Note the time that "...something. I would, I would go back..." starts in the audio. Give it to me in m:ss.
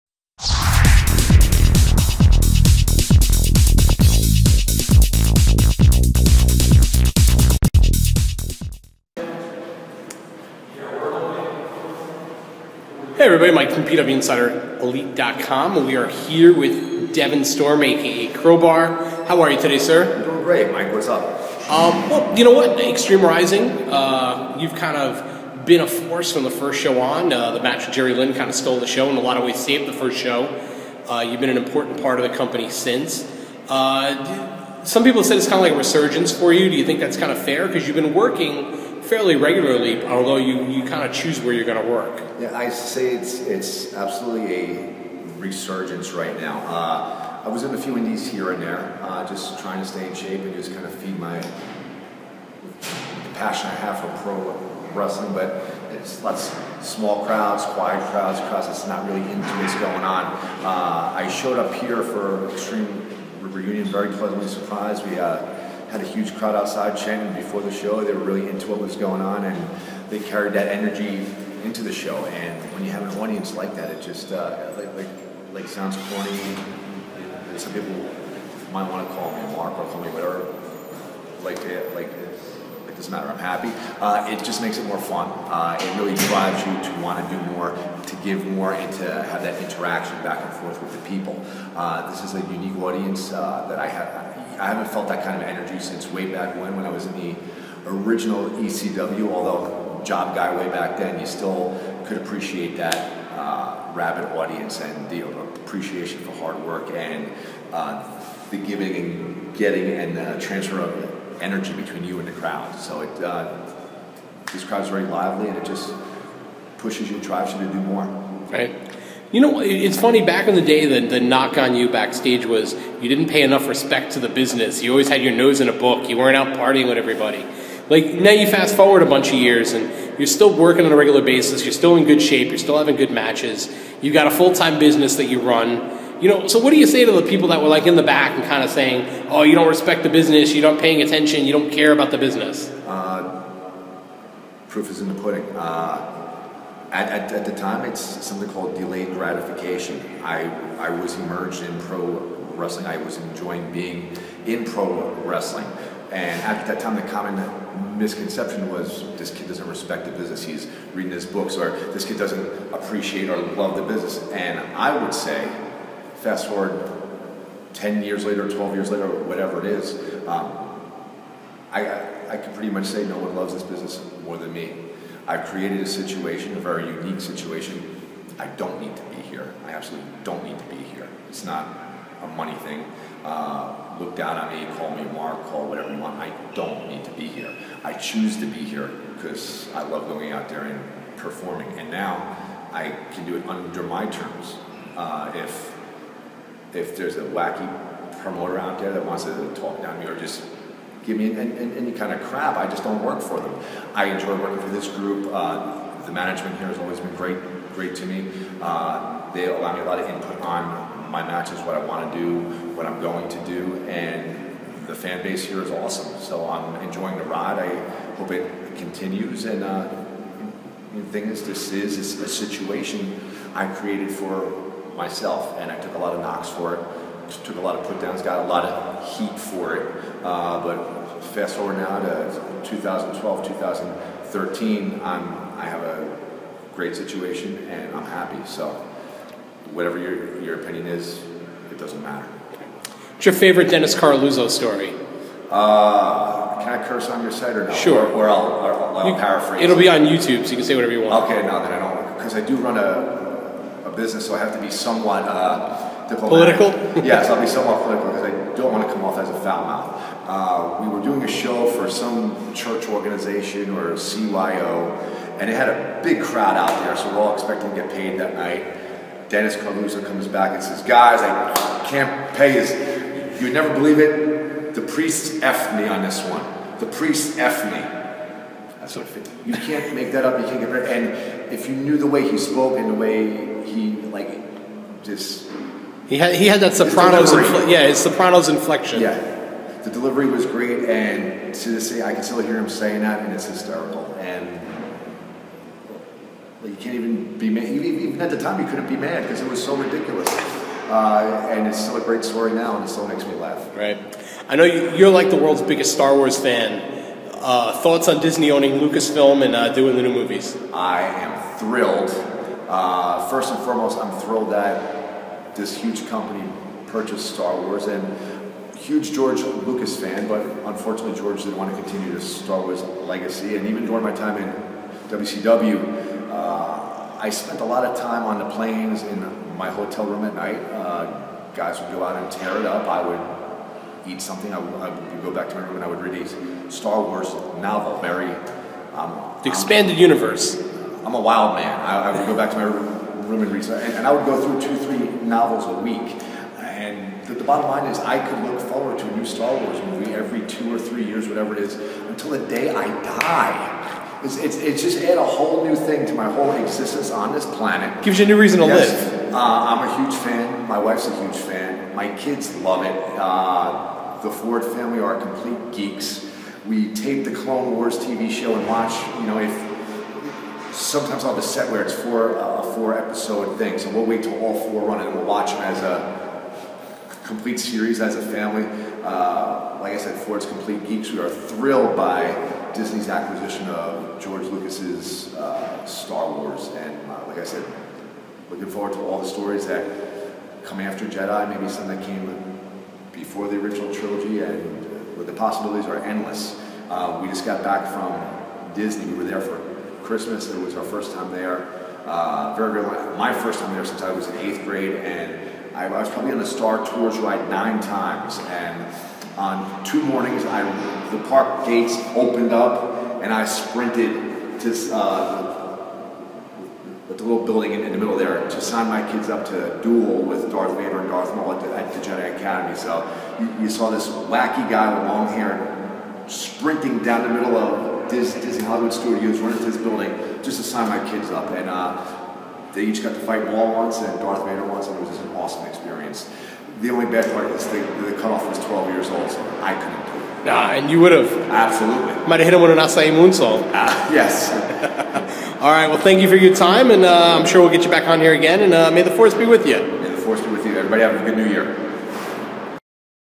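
5:34.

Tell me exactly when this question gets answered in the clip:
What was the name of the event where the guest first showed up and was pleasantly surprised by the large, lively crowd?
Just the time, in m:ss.
1:02.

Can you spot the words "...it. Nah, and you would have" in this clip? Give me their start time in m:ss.
7:20.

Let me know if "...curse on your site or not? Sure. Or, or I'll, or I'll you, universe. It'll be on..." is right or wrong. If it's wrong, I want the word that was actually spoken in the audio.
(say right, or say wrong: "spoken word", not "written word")
wrong: "paraphrase", not "universe".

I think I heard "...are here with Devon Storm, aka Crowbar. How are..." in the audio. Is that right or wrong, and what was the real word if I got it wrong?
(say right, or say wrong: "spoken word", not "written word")
right.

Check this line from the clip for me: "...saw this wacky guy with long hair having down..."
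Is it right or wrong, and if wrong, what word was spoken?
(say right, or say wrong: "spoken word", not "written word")
wrong: "sprinting", not "having".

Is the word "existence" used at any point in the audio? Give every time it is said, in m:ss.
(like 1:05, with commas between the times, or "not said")
5:56.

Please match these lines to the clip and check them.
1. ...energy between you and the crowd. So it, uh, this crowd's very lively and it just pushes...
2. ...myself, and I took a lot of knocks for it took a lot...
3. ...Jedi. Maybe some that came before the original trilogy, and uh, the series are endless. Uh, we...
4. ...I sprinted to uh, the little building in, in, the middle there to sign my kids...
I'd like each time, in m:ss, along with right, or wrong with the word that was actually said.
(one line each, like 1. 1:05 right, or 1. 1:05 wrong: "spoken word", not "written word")
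1. 1:51 right
2. 3:44 right
3. 6:31 wrong: "possibilities", not "series"
4. 6:53 right.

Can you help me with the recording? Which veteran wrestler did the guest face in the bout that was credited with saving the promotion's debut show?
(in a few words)
Jerry Lynn.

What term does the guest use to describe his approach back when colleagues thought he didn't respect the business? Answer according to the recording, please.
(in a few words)
delayed gratification.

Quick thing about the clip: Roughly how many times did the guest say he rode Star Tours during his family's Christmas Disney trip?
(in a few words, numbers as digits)
9.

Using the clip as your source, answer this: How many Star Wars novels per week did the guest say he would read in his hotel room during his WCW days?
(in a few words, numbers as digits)
2 or 3.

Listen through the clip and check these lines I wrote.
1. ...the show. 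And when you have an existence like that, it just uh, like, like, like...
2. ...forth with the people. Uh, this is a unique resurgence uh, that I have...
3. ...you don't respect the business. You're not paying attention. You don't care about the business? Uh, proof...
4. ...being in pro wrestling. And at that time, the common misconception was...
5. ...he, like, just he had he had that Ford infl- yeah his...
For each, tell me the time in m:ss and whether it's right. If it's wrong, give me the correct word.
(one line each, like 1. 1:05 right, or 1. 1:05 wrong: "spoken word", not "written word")
1. 1:11 wrong: "audience", not "existence"
2. 1:30 wrong: "audience", not "resurgence"
3. 2:19 right
4. 2:33 right
5. 4:43 wrong: "Sopranos", not "Ford".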